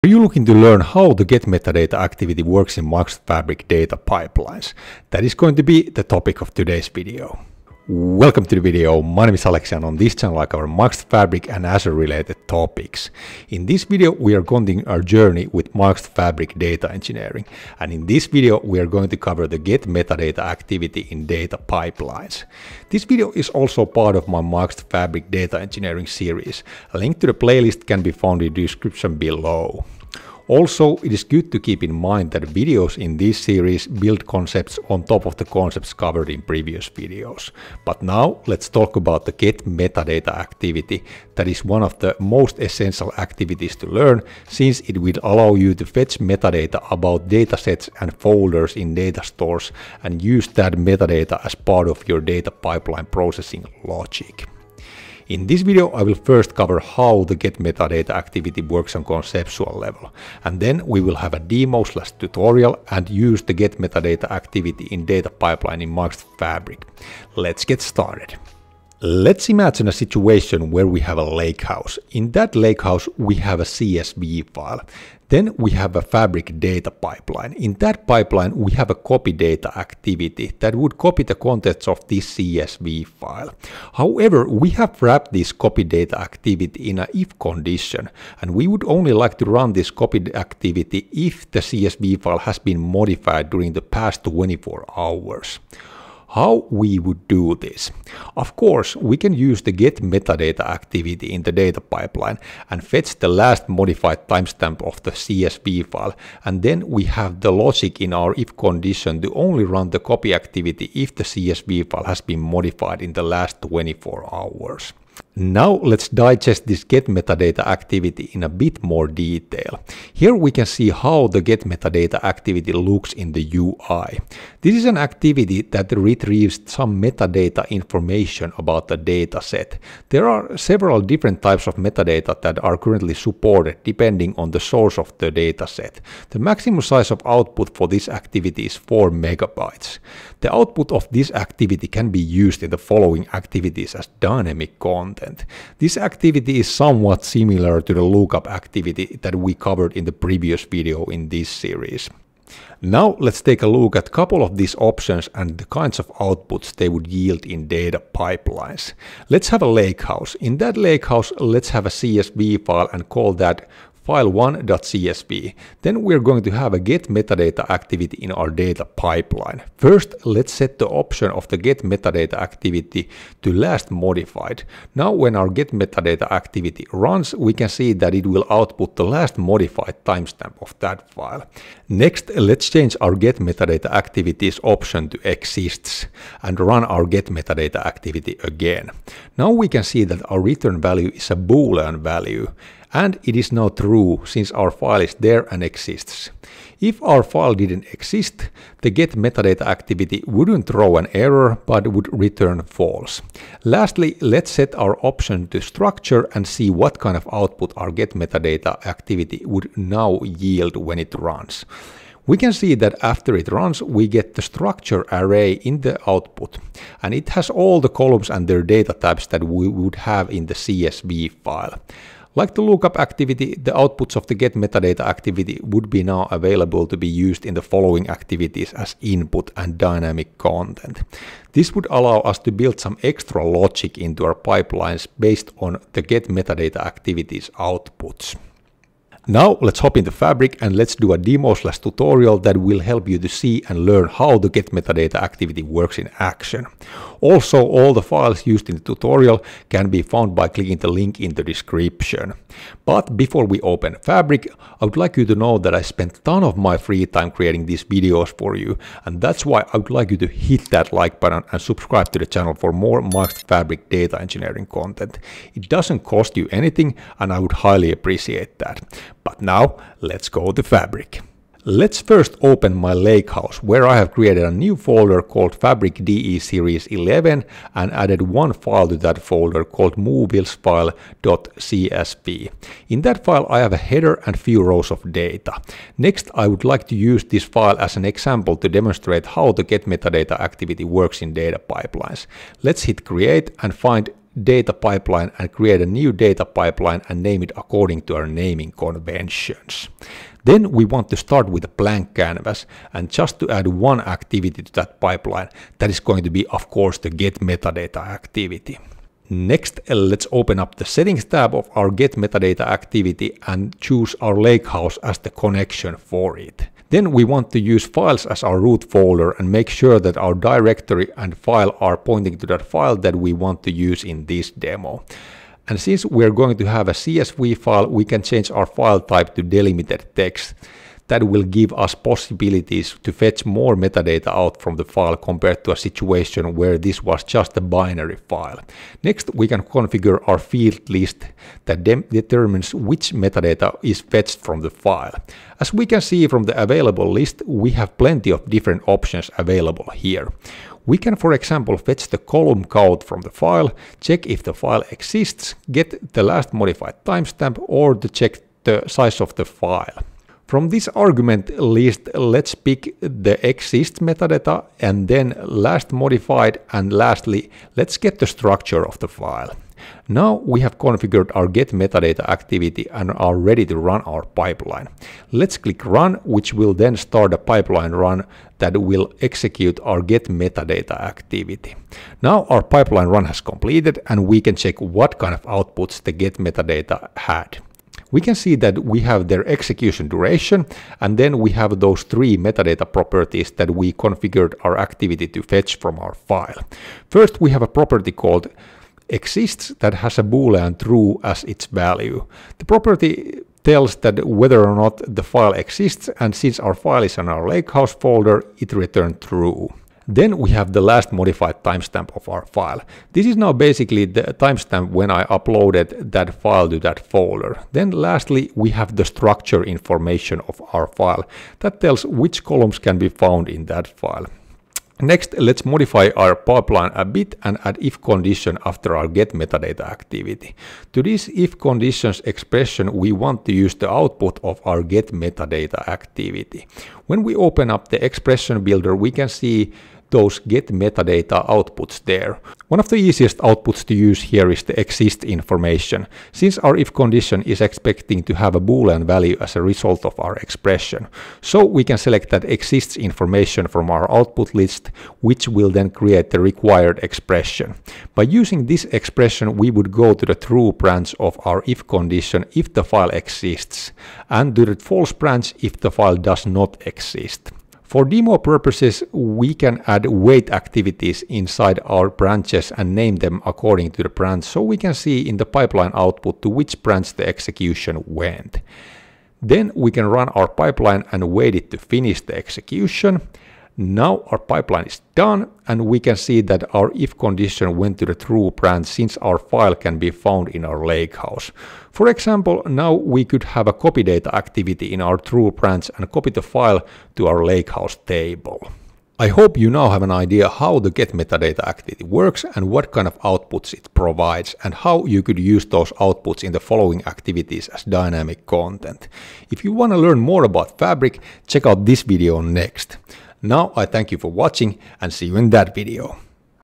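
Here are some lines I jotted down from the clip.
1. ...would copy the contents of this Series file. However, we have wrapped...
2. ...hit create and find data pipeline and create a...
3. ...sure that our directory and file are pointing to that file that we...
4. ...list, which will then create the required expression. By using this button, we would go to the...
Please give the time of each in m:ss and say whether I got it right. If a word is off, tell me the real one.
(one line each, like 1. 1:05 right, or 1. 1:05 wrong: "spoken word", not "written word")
1. 1:20 wrong: "CSV", not "Series"
2. 4:52 right
3. 5:19 right
4. 7:34 wrong: "expression", not "button".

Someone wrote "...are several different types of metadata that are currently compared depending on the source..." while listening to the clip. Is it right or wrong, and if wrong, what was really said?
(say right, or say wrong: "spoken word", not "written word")
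wrong: "supported", not "compared".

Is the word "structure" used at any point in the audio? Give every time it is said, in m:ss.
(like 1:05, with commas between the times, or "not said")
3:25, 3:34, 6:08, 6:59.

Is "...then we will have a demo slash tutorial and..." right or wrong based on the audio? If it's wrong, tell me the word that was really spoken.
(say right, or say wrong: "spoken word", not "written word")
right.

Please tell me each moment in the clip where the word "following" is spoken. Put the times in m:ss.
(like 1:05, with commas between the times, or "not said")
2:22, 3:47, 8:26.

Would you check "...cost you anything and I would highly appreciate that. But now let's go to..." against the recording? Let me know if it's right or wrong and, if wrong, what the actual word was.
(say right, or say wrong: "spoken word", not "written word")
right.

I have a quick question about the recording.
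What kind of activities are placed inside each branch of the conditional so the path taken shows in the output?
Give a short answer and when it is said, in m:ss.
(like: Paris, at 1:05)
wait activities, at 7:50.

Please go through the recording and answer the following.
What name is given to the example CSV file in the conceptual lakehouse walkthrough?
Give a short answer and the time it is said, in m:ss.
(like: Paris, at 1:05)
file1.csv, at 2:44.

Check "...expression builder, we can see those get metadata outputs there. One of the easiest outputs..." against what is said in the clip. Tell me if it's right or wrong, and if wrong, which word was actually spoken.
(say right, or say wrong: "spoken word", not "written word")
right.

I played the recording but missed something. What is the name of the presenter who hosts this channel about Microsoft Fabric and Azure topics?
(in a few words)
Aleksi.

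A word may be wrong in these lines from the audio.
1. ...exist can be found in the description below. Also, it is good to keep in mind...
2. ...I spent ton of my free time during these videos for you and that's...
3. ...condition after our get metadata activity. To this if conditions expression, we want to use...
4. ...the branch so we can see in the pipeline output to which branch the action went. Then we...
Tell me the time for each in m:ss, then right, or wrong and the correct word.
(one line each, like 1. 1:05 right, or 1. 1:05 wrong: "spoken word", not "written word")
1. 0:27 wrong: "playlist", not "exist"
2. 4:15 wrong: "creating", not "during"
3. 7:08 right
4. 7:54 wrong: "execution", not "action".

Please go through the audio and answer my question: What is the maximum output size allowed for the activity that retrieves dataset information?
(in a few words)
4 megabytes.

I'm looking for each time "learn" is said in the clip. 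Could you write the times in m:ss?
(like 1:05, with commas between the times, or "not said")
0:00, 0:43, 4:03, 8:29.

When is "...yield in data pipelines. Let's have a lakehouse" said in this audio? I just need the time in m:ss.
2:37.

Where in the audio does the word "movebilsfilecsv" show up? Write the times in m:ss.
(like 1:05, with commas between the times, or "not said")
4:39.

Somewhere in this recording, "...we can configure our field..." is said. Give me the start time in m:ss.
5:39.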